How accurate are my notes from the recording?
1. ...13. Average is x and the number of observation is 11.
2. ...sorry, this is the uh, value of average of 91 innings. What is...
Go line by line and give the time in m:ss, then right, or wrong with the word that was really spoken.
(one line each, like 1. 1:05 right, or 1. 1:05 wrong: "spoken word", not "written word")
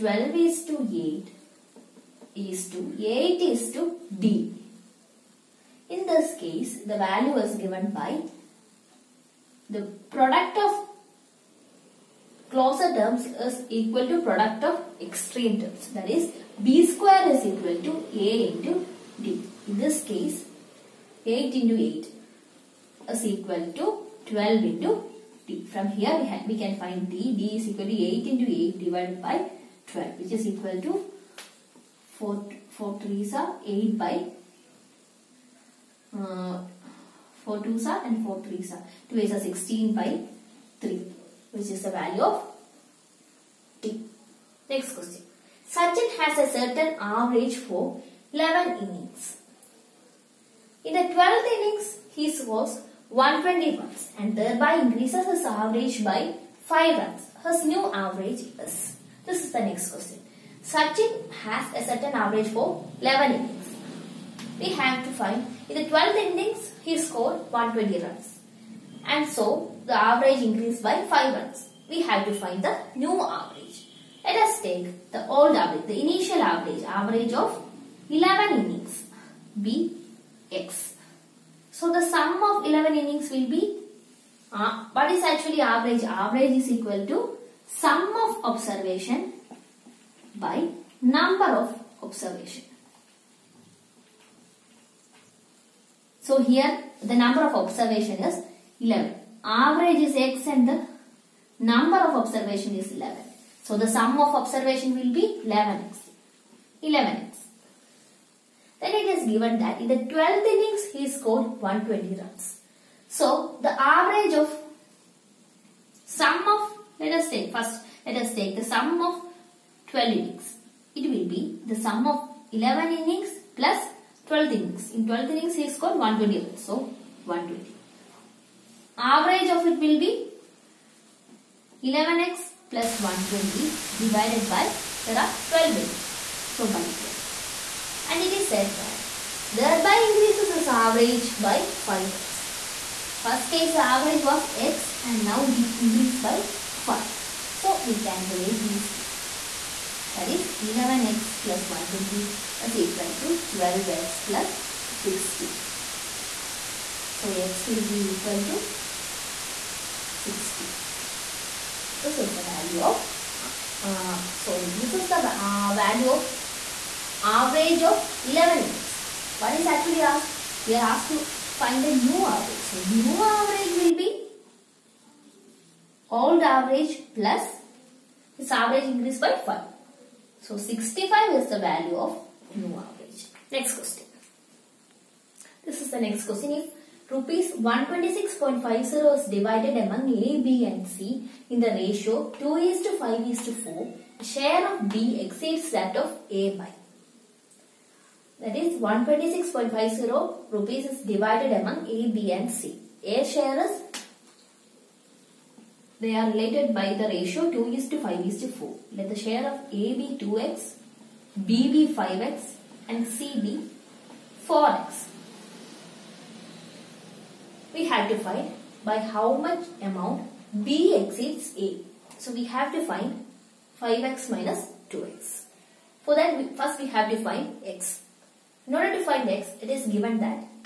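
1. 1:38 wrong: "11", not "13"
2. 2:44 wrong: "11", not "91".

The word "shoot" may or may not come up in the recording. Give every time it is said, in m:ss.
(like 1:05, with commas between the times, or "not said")
not said.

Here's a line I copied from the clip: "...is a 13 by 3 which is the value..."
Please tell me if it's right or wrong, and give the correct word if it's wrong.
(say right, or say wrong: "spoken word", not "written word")
wrong: "16", not "13".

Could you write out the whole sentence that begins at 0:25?
From here, we, have, we can find d.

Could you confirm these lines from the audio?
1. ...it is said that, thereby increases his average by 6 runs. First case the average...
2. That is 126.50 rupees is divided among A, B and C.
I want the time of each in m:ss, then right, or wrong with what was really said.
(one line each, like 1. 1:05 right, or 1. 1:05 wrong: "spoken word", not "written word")
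1. 2:18 wrong: "5", not "6"
2. 3:18 right.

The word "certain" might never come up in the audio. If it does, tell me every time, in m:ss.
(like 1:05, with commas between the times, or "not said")
0:46, 1:01.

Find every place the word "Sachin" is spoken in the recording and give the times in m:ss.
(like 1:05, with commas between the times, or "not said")
0:45, 1:00.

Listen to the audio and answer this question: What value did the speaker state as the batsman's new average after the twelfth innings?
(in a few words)
65.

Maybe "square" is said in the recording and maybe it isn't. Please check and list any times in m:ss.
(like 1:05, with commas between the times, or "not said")
0:16.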